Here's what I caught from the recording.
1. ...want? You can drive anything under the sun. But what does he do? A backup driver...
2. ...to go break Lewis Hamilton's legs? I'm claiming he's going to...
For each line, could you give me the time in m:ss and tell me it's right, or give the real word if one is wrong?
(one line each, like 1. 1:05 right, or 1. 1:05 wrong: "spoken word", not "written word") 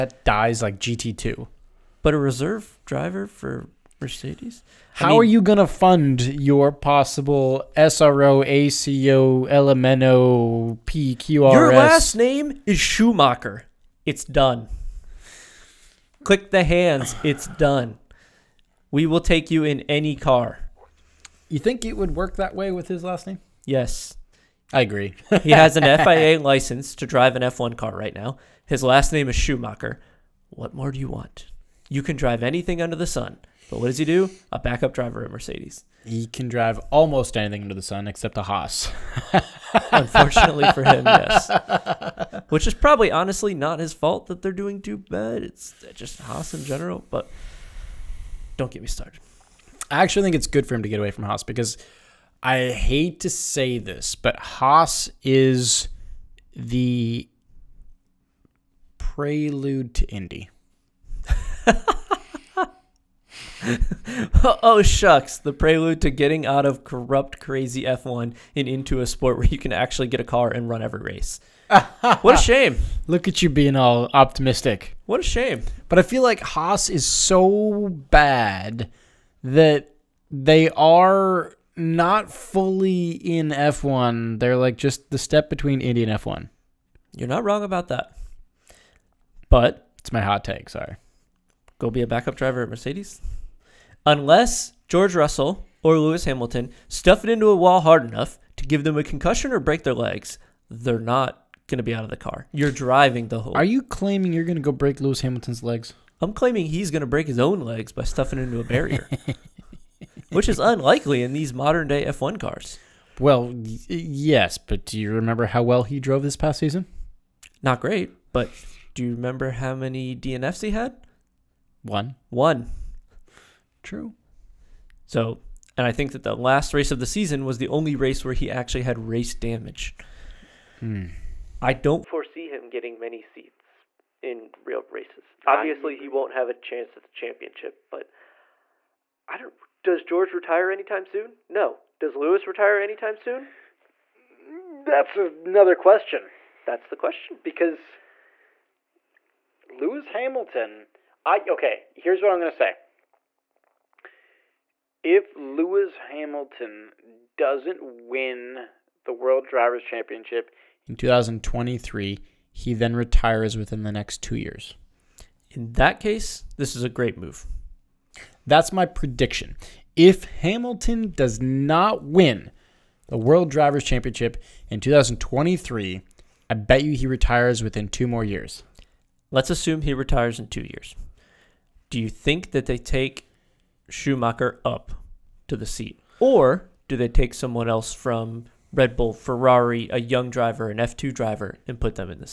1. 0:31 right
2. 1:44 right.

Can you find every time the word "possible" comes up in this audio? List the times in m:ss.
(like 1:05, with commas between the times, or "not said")
0:06.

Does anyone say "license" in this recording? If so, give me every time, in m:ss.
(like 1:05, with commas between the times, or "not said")
0:26.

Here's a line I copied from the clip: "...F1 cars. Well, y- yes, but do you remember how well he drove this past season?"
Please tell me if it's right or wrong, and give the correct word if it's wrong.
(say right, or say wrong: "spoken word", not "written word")
right.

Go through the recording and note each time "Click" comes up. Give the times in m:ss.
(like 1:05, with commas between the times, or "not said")
0:16.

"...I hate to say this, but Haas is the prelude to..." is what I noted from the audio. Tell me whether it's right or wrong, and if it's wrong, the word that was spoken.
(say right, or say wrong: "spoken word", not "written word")
right.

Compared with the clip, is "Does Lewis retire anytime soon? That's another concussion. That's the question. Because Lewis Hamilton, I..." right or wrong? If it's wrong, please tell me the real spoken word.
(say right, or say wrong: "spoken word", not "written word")
wrong: "question", not "concussion".